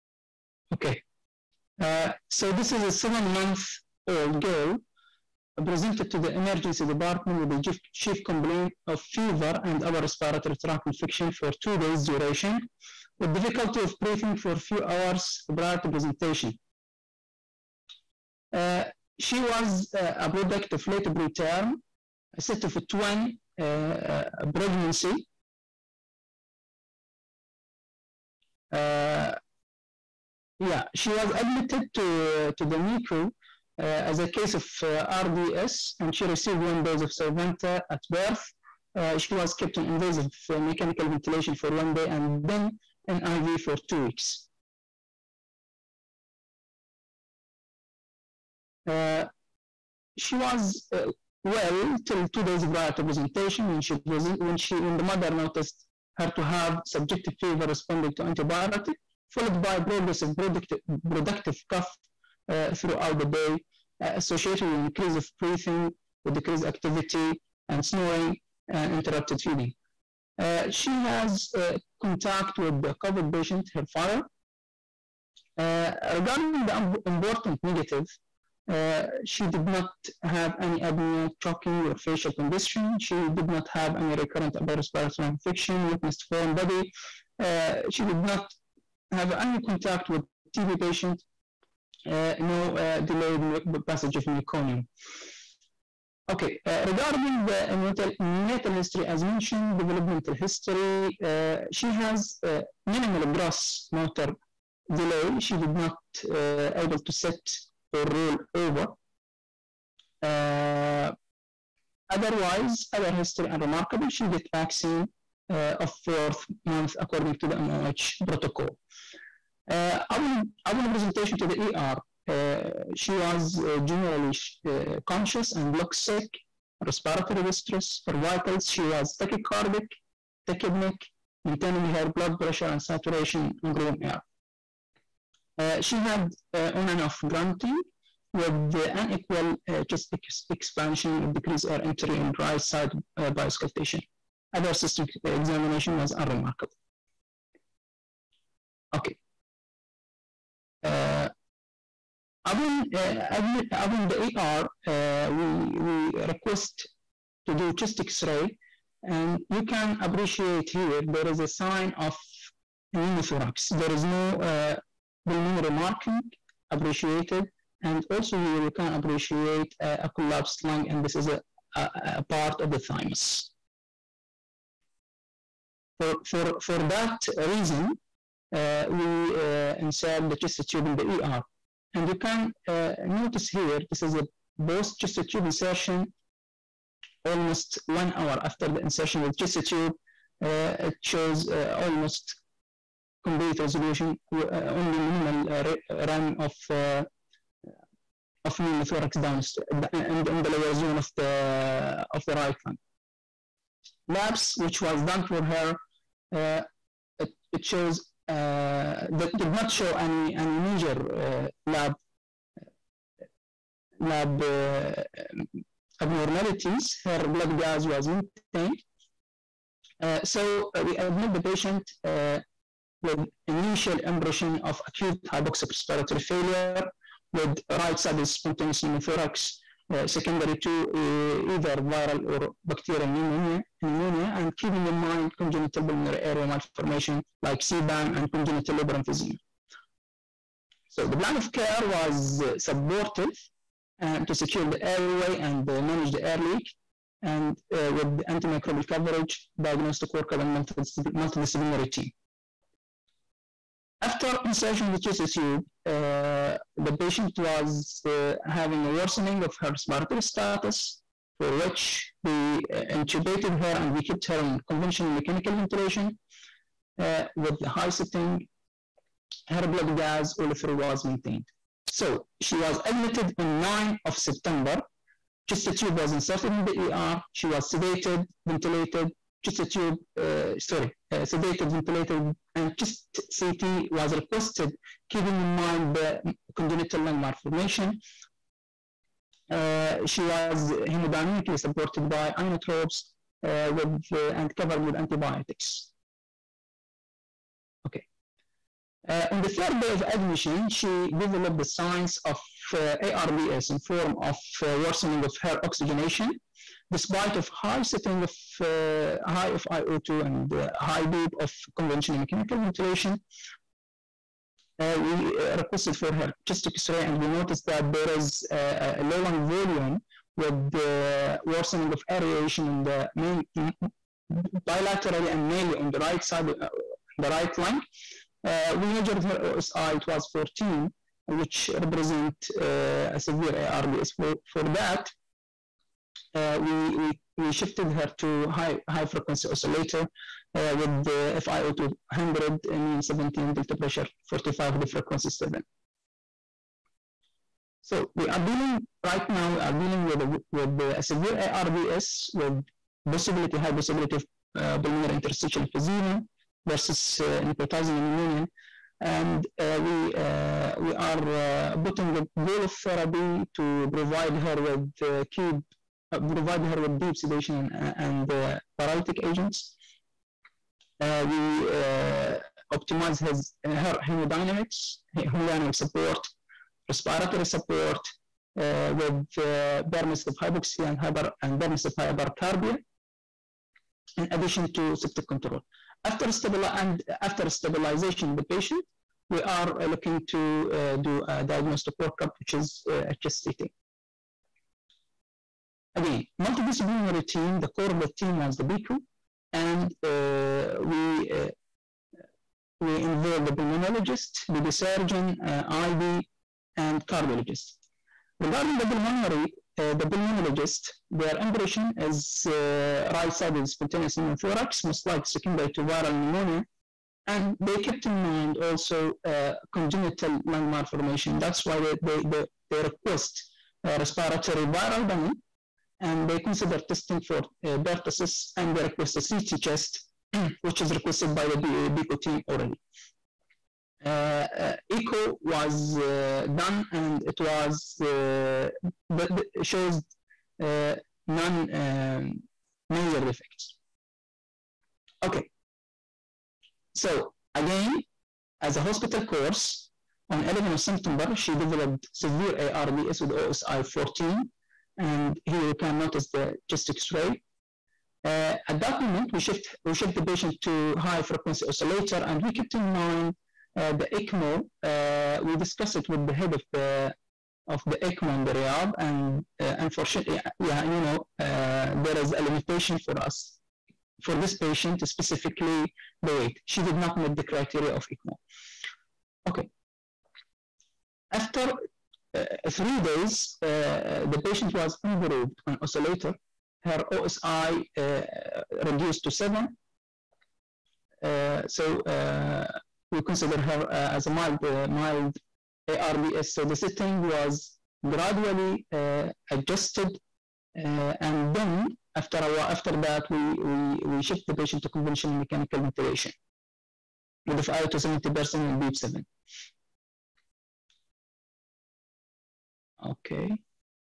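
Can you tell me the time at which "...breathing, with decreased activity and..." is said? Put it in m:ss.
1:05.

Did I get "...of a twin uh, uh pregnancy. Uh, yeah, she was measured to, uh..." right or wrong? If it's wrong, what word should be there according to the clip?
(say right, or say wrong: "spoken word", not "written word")
wrong: "admitted", not "measured".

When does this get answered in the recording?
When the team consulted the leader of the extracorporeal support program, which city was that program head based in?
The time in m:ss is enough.
7:48.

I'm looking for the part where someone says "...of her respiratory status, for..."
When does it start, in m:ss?
4:19.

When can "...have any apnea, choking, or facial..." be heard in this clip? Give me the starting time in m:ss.
1:20.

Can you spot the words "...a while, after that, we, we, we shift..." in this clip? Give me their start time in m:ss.
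8:22.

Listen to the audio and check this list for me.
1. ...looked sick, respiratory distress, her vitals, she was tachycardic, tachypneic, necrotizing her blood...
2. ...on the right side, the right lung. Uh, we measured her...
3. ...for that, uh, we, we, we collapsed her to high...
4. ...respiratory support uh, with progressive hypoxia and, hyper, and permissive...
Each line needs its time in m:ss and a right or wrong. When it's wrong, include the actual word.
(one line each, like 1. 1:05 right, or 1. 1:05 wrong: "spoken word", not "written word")
1. 2:05 wrong: "maintaining", not "necrotizing"
2. 5:25 right
3. 5:34 wrong: "shifted", not "collapsed"
4. 6:16 wrong: "permissive", not "progressive".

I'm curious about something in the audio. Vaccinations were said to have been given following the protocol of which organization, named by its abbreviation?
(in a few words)
MOH.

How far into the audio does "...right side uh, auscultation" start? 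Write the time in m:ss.
2:22.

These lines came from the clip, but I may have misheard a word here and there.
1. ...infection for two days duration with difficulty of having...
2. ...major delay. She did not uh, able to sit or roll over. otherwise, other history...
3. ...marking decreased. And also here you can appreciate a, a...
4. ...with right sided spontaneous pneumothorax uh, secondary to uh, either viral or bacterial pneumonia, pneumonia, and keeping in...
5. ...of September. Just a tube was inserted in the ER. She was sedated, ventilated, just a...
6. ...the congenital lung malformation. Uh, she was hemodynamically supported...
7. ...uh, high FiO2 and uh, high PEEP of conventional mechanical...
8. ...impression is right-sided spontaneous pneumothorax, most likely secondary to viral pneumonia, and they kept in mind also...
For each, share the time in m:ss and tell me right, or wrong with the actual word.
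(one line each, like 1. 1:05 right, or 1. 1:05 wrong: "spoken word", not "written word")
1. 0:10 wrong: "breathing", not "having"
2. 1:43 wrong: "motor", not "major"
3. 2:45 wrong: "appreciated", not "decreased"
4. 3:47 right
5. 4:34 right
6. 4:45 right
7. 5:08 right
8. 6:51 right.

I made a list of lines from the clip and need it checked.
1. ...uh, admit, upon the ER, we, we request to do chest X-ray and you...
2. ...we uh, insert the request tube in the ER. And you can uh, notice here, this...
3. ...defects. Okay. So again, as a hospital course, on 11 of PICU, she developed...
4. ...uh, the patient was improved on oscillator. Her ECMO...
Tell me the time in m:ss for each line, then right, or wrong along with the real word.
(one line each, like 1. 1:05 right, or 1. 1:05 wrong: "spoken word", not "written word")
1. 2:32 right
2. 2:58 wrong: "chest", not "request"
3. 7:23 wrong: "September", not "PICU"
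4. 8:03 wrong: "OSI", not "ECMO".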